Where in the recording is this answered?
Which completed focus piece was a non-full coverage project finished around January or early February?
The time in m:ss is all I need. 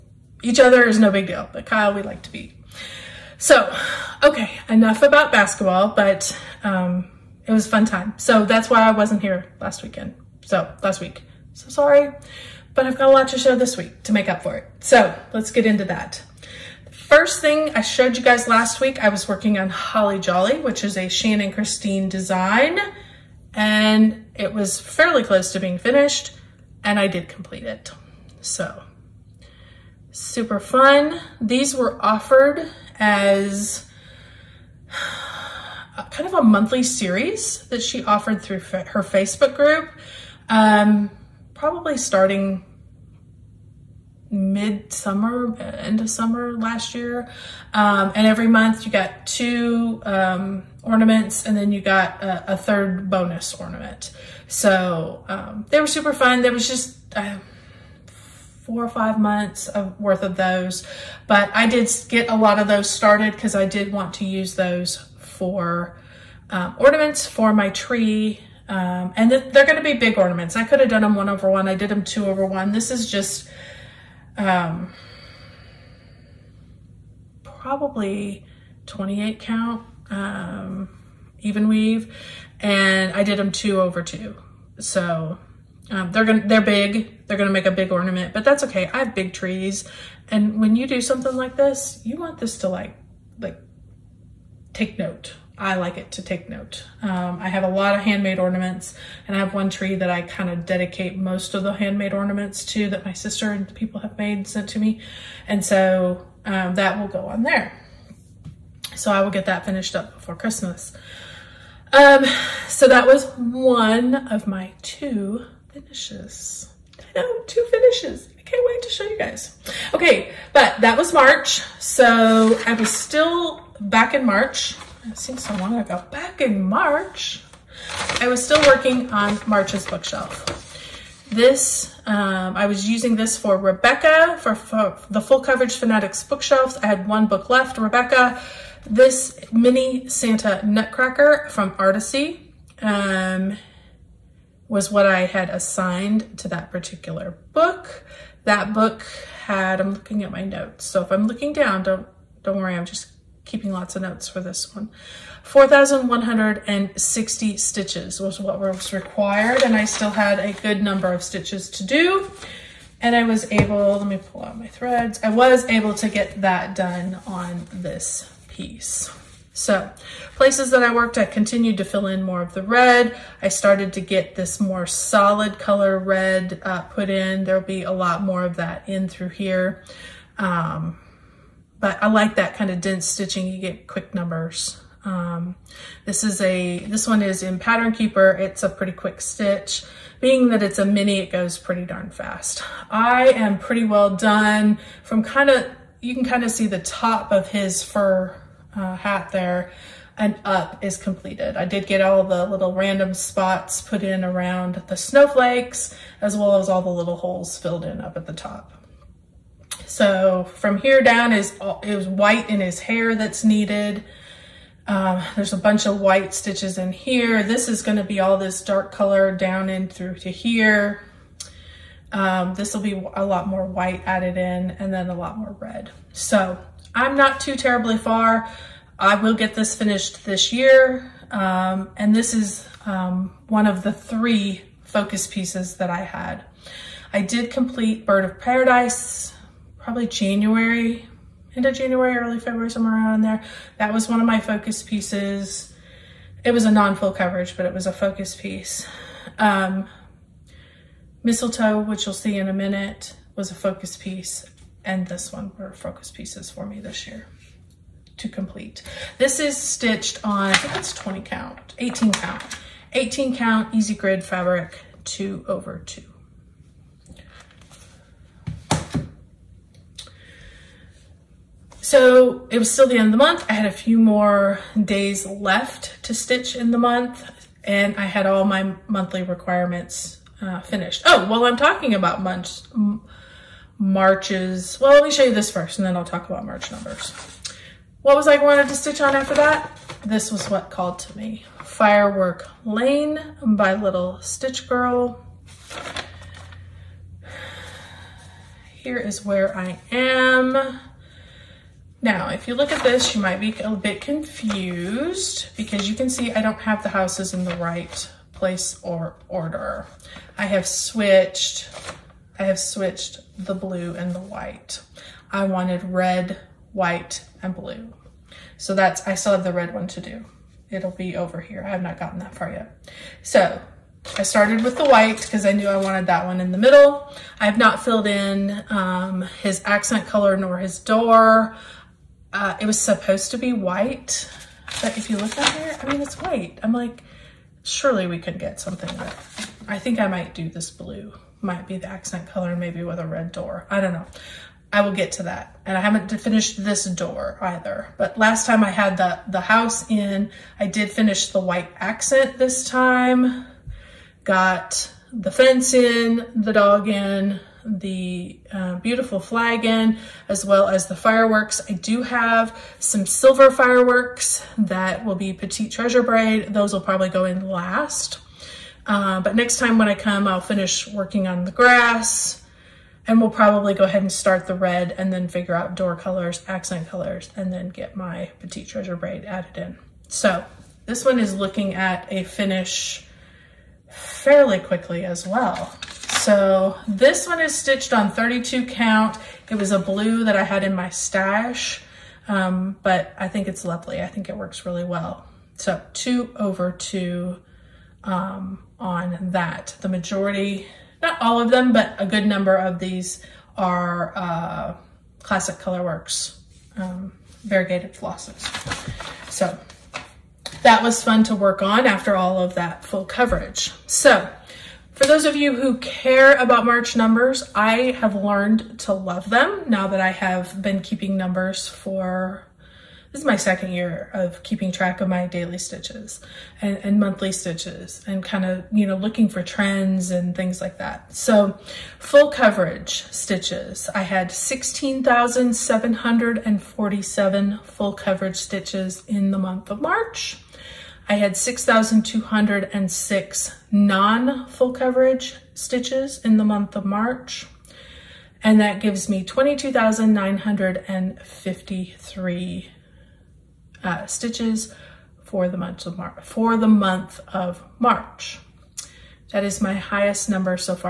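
3:58.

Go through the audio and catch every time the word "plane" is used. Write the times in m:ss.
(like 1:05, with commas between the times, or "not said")
not said.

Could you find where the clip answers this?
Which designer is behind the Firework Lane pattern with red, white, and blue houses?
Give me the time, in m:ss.
4:53.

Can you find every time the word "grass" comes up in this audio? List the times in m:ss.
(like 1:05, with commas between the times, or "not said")
6:11.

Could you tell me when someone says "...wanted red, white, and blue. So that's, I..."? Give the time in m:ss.
5:15.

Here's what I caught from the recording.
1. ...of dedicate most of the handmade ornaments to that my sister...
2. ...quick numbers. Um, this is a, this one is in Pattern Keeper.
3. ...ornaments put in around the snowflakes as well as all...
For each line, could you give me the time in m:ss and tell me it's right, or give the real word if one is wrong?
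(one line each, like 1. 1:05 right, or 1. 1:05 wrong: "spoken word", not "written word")
1. 1:40 right
2. 3:03 right
3. 3:23 wrong: "spots", not "ornaments".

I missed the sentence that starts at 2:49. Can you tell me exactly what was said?
So places that I worked, I continued to fill in more of the red.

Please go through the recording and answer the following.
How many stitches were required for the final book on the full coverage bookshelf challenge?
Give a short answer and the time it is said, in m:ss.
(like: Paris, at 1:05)
4,160, at 2:35.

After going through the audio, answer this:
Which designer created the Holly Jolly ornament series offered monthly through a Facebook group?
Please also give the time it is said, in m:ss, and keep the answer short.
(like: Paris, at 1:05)
Shannon Christine, at 0:21.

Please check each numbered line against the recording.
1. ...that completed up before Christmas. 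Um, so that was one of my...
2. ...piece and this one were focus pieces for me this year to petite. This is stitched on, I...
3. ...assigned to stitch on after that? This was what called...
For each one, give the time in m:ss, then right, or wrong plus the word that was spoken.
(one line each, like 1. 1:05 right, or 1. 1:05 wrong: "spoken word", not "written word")
1. 1:49 wrong: "finished", not "completed"
2. 4:13 wrong: "complete", not "petite"
3. 4:48 wrong: "wanted", not "assigned".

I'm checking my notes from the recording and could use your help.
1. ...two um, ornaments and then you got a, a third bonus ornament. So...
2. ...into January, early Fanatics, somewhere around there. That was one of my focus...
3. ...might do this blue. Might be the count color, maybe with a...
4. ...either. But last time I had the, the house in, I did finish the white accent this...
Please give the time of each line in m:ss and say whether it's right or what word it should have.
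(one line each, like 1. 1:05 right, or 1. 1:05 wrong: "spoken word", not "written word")
1. 0:49 right
2. 4:01 wrong: "February", not "Fanatics"
3. 5:40 wrong: "accent", not "count"
4. 5:47 right.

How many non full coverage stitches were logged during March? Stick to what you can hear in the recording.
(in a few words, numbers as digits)
6,206.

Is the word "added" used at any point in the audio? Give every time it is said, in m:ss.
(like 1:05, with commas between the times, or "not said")
3:44, 6:19.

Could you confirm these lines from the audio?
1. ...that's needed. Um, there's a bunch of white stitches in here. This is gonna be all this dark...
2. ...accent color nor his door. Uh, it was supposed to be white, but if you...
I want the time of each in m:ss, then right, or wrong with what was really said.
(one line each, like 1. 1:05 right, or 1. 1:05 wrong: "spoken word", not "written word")
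1. 3:33 right
2. 5:29 right.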